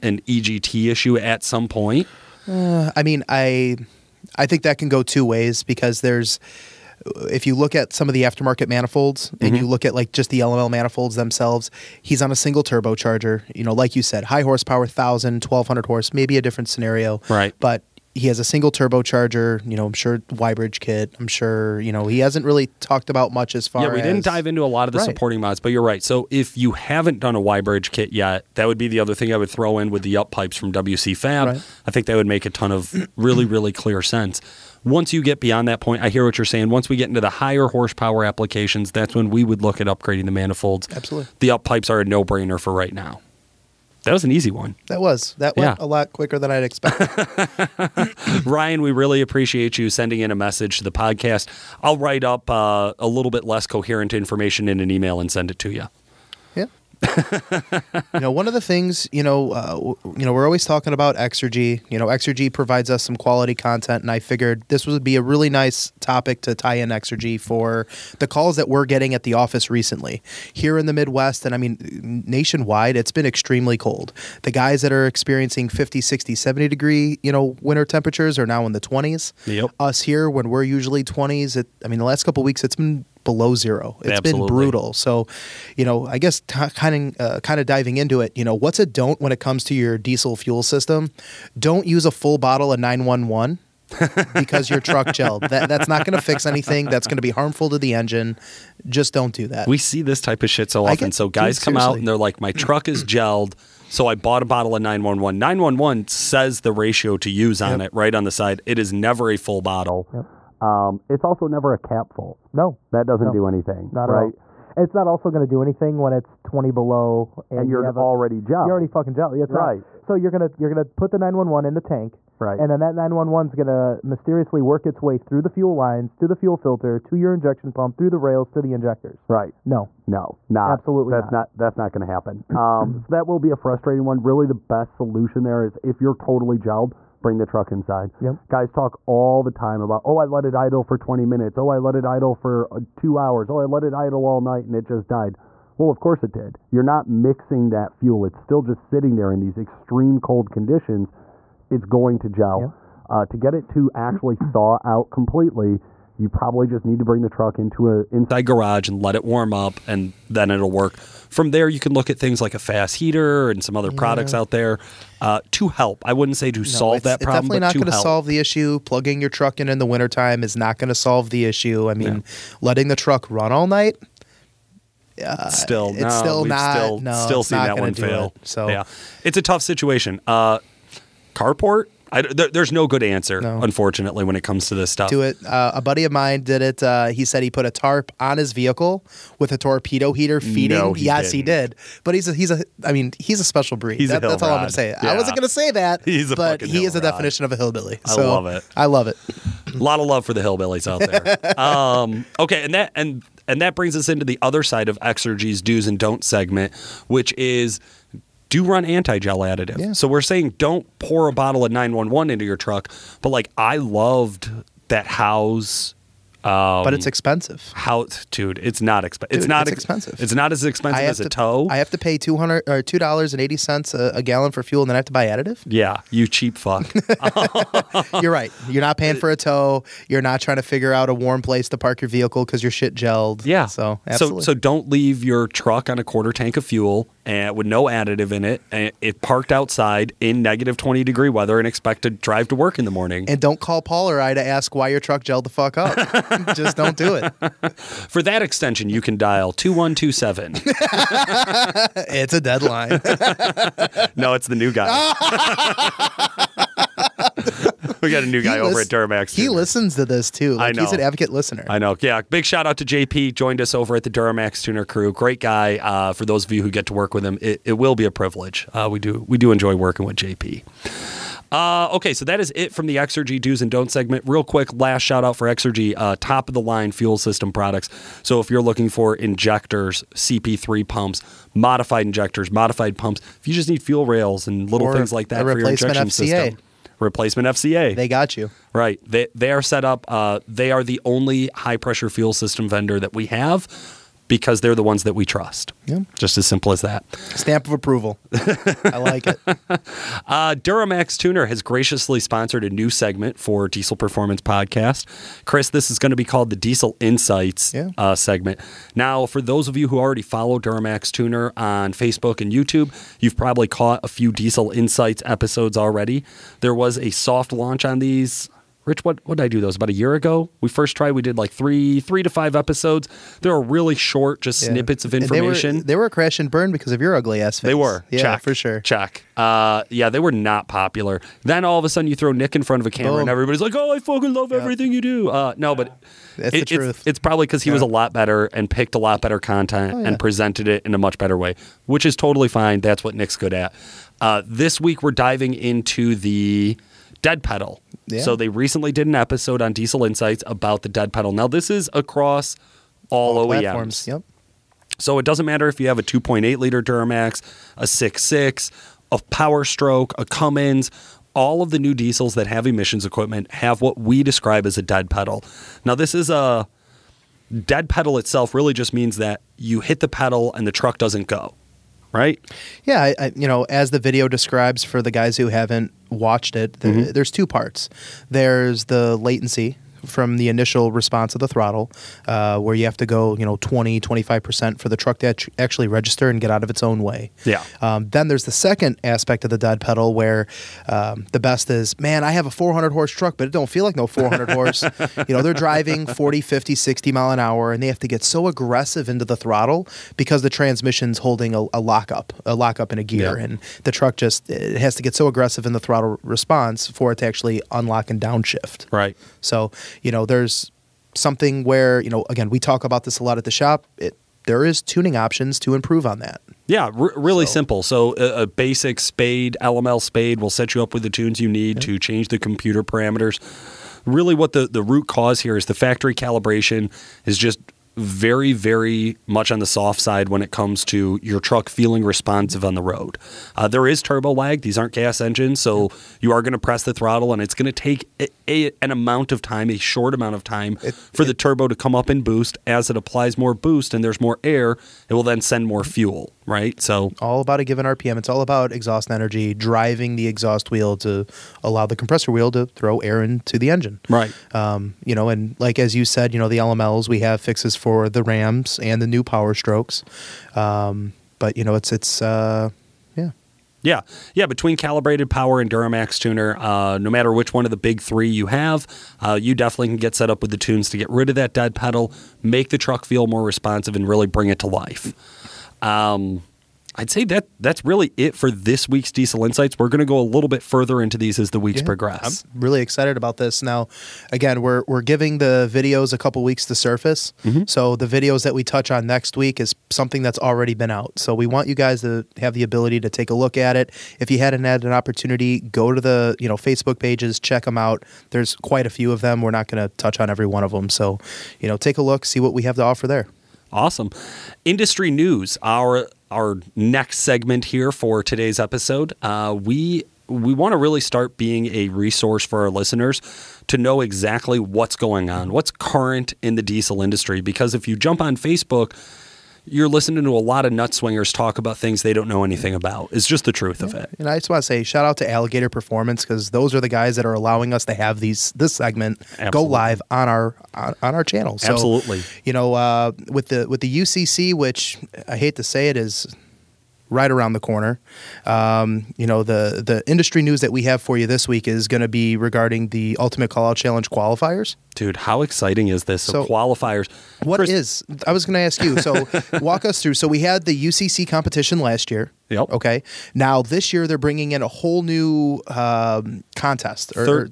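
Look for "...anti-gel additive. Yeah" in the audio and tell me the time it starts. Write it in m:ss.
3:28.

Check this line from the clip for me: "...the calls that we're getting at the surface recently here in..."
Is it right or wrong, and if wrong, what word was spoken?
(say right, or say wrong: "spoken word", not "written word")
wrong: "office", not "surface".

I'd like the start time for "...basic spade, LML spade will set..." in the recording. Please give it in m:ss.
6:58.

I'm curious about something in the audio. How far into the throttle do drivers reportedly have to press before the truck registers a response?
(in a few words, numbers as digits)
20 to 25%.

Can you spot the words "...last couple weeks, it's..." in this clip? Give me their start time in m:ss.
1:22.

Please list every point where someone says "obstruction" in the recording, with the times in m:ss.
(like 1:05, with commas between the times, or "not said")
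not said.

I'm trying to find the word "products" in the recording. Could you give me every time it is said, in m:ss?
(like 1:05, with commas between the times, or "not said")
2:43, 4:37.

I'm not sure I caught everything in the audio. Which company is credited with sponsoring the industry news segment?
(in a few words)
Alligator Performance.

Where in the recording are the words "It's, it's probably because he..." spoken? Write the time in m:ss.
5:36.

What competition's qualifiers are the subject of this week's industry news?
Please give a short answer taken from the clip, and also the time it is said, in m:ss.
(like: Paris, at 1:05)
Ultimate Call Out Challenge, at 9:03.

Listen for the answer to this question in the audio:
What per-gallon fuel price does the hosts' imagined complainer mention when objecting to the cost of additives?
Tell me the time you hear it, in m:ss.
3:42.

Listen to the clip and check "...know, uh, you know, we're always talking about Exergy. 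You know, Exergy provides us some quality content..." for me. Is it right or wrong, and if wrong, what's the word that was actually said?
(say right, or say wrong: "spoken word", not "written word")
right.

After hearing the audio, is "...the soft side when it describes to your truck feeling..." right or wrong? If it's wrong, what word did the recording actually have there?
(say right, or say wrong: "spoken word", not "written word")
wrong: "comes", not "describes".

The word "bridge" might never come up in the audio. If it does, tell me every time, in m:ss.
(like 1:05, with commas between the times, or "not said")
0:20, 0:27.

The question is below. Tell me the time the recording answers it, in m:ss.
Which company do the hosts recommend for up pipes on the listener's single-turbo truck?
0:30.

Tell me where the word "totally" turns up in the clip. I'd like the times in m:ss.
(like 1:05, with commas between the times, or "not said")
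2:16, 5:42.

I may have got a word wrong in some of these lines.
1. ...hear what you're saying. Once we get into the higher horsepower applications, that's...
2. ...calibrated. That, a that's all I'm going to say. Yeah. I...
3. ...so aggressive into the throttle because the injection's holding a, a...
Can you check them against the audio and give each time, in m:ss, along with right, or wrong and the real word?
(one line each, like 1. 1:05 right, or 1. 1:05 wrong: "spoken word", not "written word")
1. 0:36 right
2. 3:13 wrong: "breed", not "calibrated"
3. 6:38 wrong: "transmission", not "injection".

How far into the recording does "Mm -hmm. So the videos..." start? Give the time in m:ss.
8:07.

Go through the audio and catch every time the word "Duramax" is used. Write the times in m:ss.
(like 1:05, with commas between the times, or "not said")
4:18, 4:24, 5:00, 5:10, 5:56, 7:45.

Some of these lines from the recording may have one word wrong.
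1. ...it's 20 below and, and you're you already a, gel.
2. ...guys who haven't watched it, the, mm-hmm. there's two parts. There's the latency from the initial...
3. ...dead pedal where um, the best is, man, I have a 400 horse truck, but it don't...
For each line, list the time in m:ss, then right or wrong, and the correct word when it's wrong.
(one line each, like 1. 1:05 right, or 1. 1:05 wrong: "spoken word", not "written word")
1. 1:56 right
2. 6:15 right
3. 6:29 right.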